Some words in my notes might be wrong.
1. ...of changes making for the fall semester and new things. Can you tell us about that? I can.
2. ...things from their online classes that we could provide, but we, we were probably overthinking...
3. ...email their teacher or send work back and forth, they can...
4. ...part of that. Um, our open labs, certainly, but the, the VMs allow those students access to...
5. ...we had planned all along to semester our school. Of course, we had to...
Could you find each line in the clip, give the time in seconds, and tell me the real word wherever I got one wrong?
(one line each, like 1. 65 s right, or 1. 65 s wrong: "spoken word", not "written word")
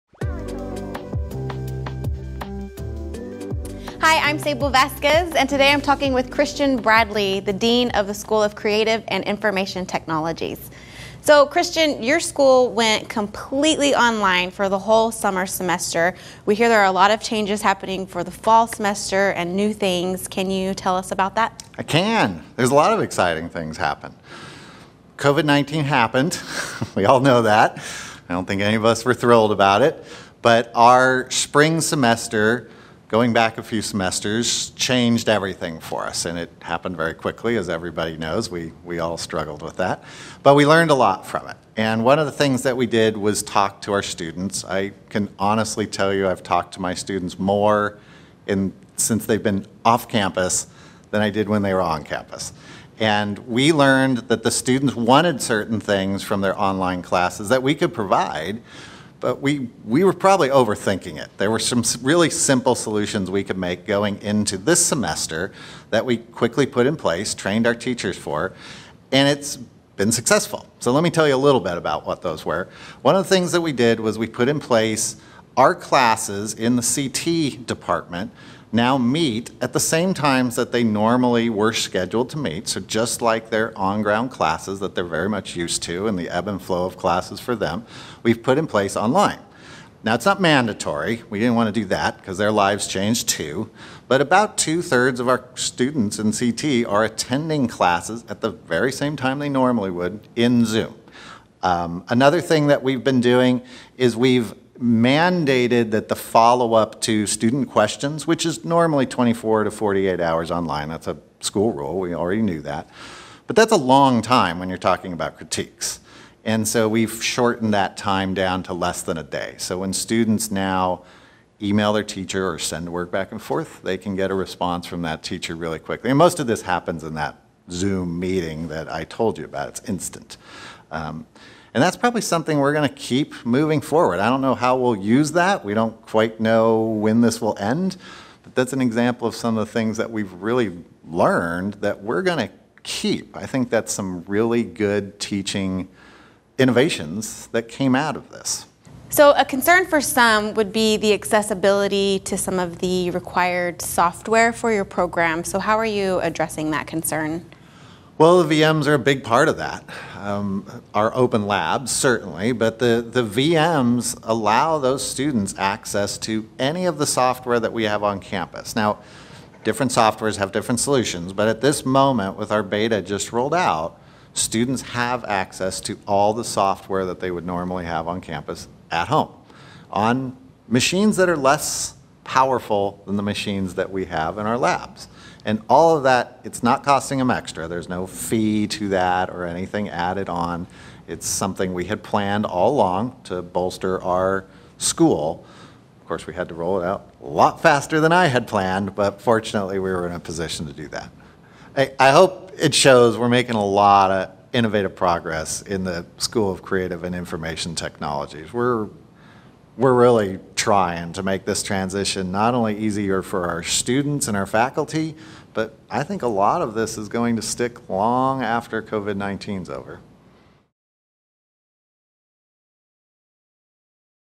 1. 17 s wrong: "happening", not "making"
2. 55 s right
3. 121 s right
4. 159 s right
5. 191 s wrong: "bolster", not "semester".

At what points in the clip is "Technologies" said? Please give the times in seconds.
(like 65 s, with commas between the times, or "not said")
9 s, 207 s.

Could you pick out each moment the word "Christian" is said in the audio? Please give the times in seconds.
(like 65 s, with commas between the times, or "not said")
6 s, 11 s.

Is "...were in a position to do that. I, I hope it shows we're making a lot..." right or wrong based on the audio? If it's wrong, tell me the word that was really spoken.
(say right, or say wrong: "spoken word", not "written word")
right.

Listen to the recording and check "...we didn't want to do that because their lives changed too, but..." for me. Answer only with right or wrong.
right.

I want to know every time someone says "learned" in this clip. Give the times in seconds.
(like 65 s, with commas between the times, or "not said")
40 s, 53 s, 141 s.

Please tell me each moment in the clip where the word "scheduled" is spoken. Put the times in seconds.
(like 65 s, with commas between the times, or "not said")
81 s.